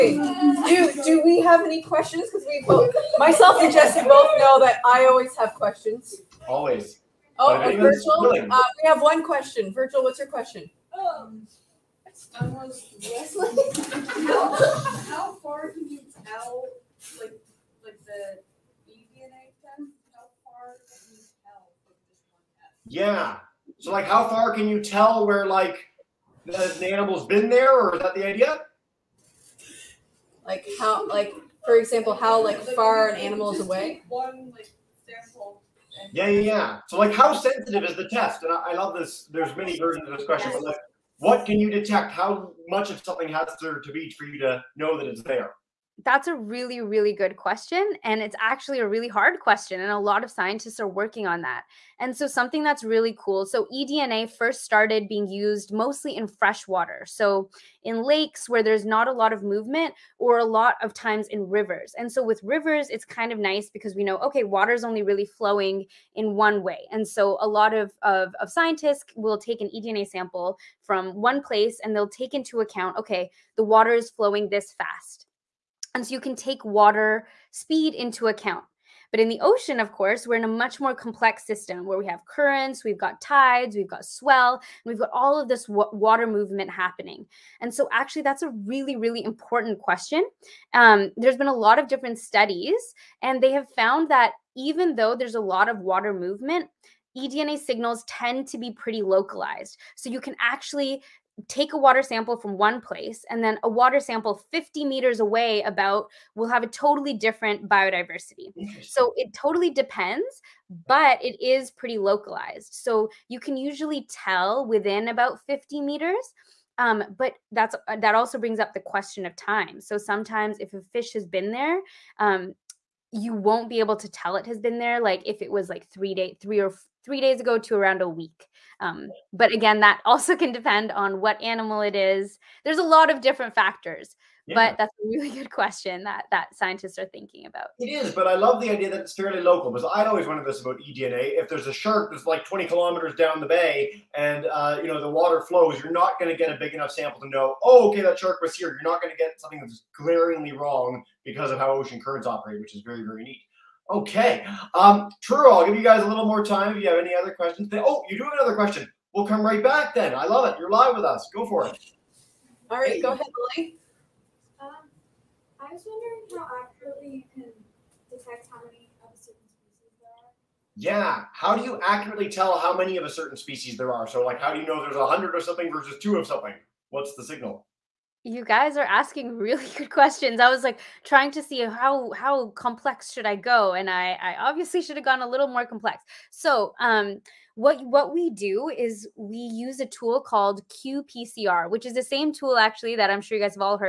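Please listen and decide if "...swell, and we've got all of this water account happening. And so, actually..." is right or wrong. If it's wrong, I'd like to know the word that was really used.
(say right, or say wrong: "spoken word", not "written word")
wrong: "movement", not "account".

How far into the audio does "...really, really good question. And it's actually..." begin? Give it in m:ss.
0:46.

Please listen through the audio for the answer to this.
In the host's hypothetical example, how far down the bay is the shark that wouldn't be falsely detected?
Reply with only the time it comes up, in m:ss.
2:22.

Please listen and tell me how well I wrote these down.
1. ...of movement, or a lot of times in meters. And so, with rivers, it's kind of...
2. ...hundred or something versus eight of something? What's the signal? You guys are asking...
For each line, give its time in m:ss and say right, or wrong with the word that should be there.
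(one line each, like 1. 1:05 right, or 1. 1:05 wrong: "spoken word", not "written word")
1. 0:59 wrong: "rivers", not "meters"
2. 2:55 wrong: "two", not "eight".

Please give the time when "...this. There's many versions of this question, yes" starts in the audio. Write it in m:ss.
0:38.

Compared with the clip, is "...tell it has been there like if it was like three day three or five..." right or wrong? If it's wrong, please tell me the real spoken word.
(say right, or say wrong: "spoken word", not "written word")
wrong: "three", not "five".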